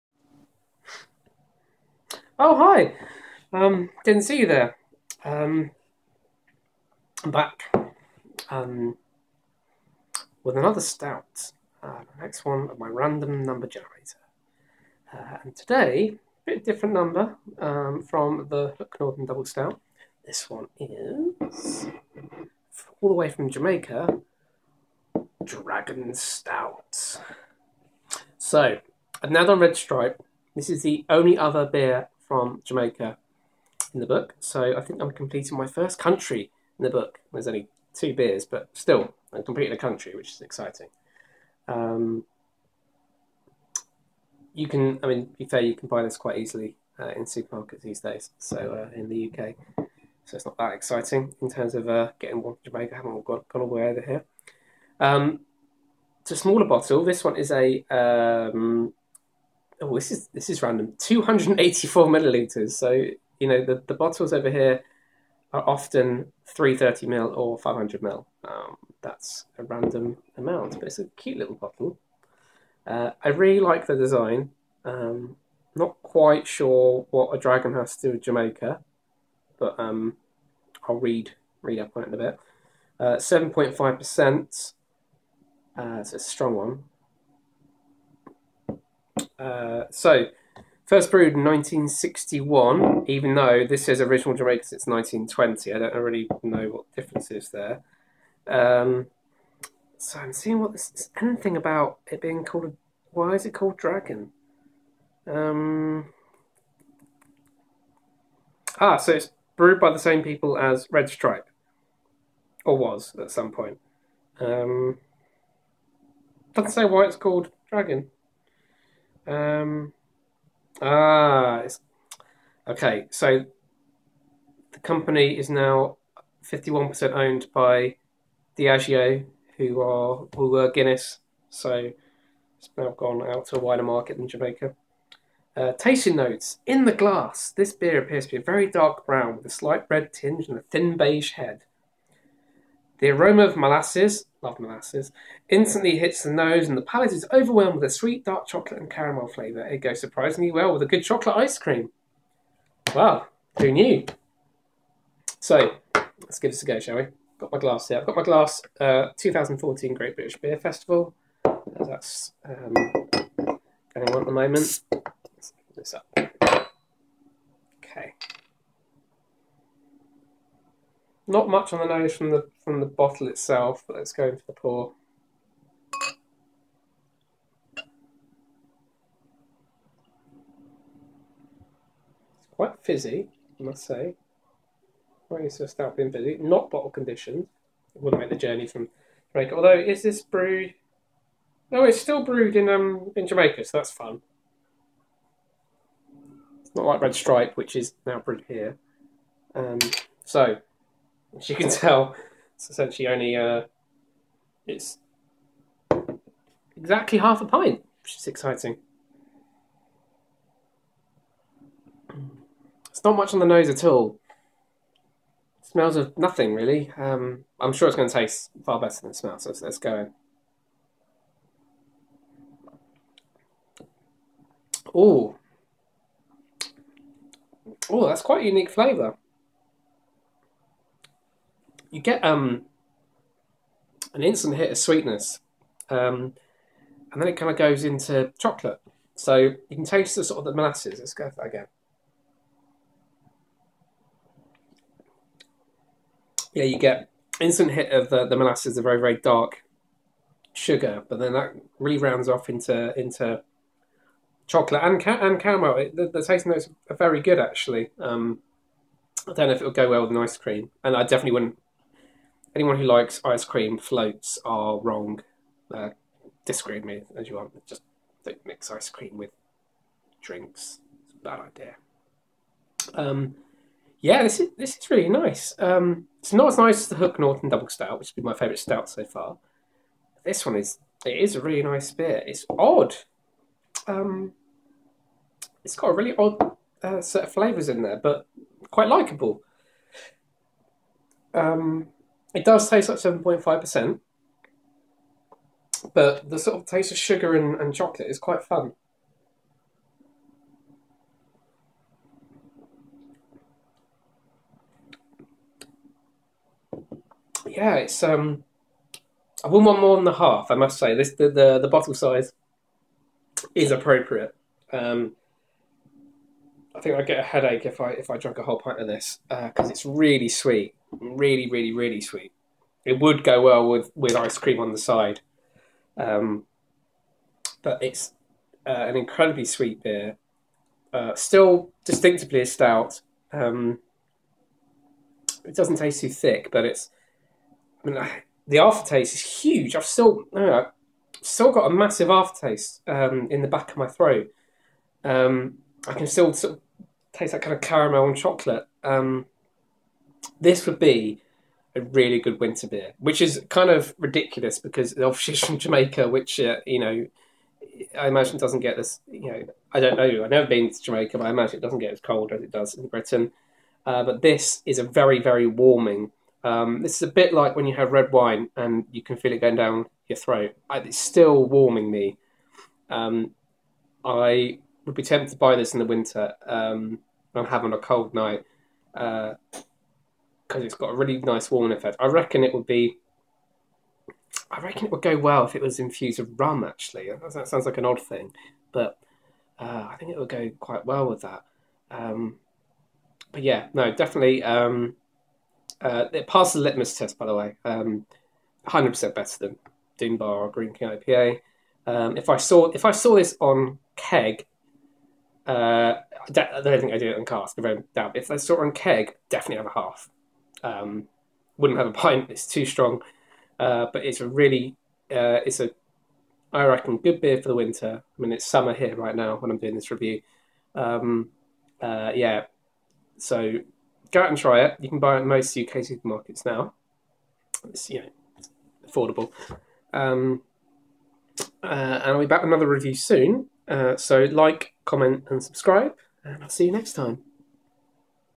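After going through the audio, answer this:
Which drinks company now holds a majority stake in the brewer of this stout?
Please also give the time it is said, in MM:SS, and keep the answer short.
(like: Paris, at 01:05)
Diageo, at 02:08.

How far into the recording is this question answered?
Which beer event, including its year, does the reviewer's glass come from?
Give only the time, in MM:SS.
02:39.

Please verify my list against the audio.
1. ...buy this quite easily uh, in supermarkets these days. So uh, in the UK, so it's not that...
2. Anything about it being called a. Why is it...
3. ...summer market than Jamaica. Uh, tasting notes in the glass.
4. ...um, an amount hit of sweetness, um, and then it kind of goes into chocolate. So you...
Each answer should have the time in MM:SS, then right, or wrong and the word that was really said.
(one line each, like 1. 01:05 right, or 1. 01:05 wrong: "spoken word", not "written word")
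1. 00:45 right
2. 01:41 right
3. 02:13 wrong: "wider", not "summer"
4. 03:52 wrong: "instant", not "amount".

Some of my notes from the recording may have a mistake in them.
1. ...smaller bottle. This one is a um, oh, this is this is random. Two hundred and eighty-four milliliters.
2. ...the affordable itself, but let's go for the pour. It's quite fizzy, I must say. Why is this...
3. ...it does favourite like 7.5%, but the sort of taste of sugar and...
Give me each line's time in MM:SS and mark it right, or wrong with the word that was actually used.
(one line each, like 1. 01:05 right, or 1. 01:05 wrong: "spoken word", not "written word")
1. 00:56 right
2. 02:52 wrong: "bottle", not "affordable"
3. 04:52 wrong: "taste", not "favourite".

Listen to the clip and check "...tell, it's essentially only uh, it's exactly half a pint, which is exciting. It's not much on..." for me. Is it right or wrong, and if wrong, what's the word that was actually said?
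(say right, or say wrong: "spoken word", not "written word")
right.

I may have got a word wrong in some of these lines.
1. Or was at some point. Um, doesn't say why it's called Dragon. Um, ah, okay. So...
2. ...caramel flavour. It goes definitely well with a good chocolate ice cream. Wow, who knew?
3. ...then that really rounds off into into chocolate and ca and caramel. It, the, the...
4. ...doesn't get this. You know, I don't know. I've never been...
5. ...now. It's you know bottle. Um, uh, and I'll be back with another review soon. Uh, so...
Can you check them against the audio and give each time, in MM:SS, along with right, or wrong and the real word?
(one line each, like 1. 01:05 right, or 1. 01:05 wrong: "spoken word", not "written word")
1. 01:52 right
2. 02:28 wrong: "surprisingly", not "definitely"
3. 04:11 right
4. 05:58 right
5. 07:06 wrong: "affordable", not "bottle".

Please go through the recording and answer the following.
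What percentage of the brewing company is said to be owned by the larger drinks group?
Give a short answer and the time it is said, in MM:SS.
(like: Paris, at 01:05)
51%, at 02:06.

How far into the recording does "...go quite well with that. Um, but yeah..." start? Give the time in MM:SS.
06:30.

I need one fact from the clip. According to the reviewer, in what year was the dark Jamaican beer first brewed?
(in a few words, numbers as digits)
1961.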